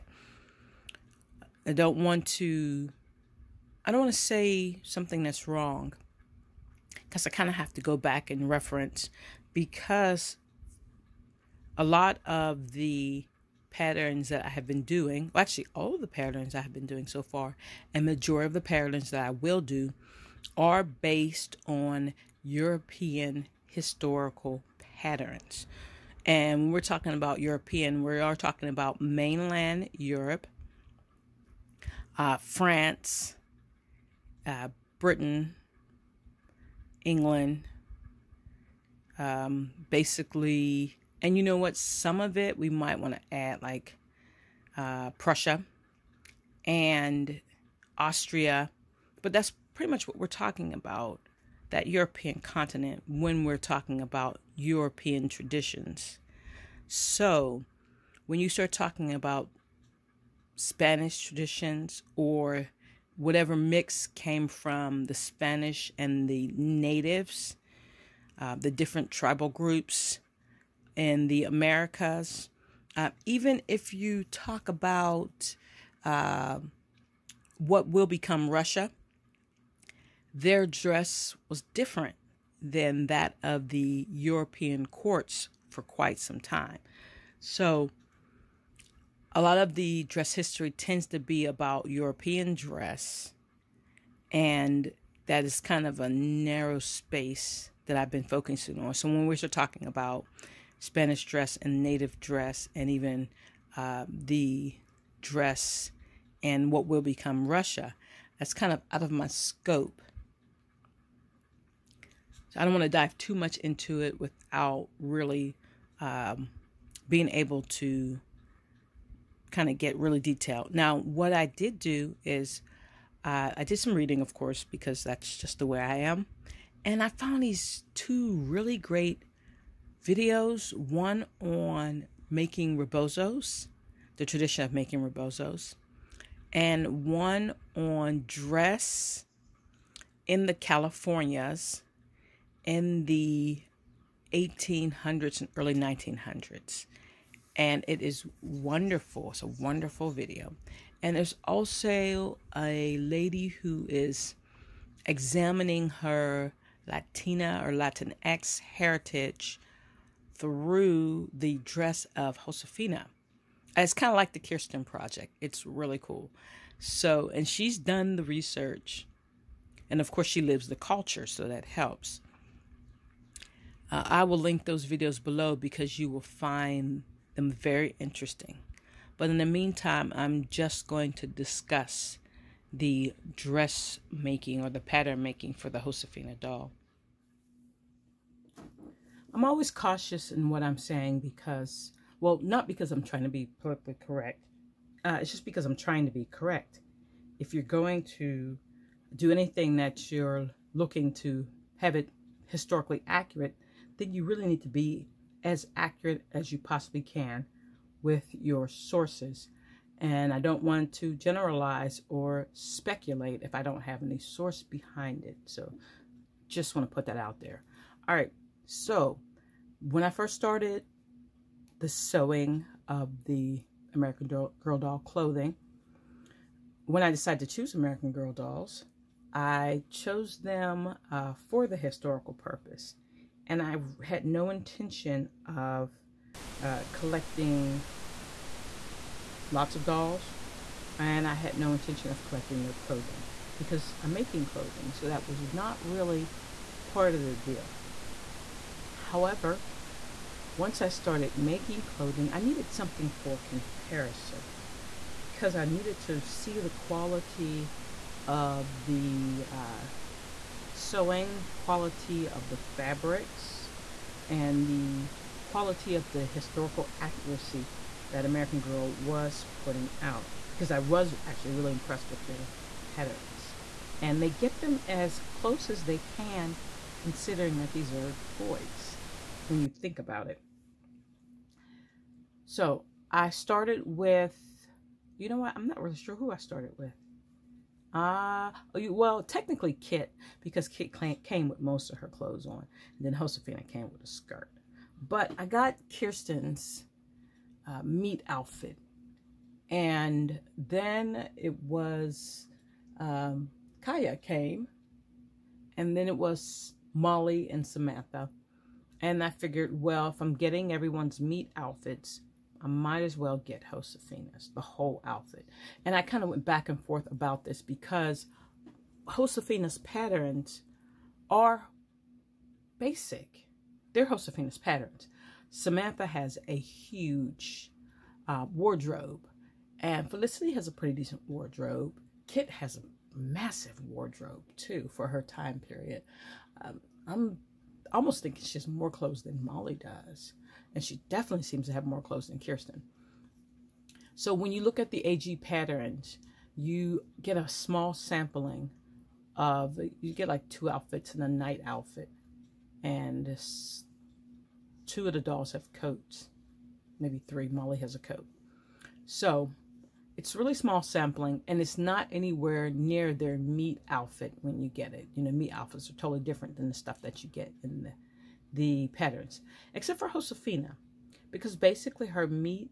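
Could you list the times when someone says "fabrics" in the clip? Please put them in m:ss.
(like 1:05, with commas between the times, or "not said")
4:22.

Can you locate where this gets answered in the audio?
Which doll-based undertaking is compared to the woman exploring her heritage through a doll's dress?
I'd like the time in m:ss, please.
2:44.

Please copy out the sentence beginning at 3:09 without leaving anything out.
I'm always cautious in what I'm saying because, well, not because I'm trying to be politically correct.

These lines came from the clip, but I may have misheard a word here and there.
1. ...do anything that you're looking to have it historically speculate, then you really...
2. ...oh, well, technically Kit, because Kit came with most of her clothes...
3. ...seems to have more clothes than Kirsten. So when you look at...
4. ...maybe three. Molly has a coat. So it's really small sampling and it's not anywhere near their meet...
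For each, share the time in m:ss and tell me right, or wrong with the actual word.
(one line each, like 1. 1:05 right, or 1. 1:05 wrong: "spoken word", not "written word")
1. 3:19 wrong: "accurate", not "speculate"
2. 4:48 right
3. 5:41 right
4. 5:57 right.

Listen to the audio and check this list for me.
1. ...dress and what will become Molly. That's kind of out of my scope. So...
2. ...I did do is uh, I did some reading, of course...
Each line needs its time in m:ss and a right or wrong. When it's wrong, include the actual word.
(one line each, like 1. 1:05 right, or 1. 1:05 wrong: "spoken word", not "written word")
1. 1:45 wrong: "Russia", not "Molly"
2. 2:01 right.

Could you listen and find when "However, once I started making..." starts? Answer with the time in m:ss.
4:08.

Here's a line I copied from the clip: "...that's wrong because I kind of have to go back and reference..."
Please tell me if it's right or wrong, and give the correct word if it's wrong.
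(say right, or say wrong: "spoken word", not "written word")
right.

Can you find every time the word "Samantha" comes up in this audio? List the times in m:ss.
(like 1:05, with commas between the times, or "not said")
5:07, 5:25.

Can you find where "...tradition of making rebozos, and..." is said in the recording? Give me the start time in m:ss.
2:14.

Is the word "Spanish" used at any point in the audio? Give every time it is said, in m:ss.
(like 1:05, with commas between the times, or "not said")
1:00, 1:05, 1:40.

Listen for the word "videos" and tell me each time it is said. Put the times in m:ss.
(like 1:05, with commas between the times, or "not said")
2:10, 2:30, 2:54.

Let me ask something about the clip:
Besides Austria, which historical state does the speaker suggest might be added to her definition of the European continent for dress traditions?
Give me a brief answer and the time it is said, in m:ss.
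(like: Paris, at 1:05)
Prussia, at 0:45.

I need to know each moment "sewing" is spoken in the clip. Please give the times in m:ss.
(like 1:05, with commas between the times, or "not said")
3:41, 4:20.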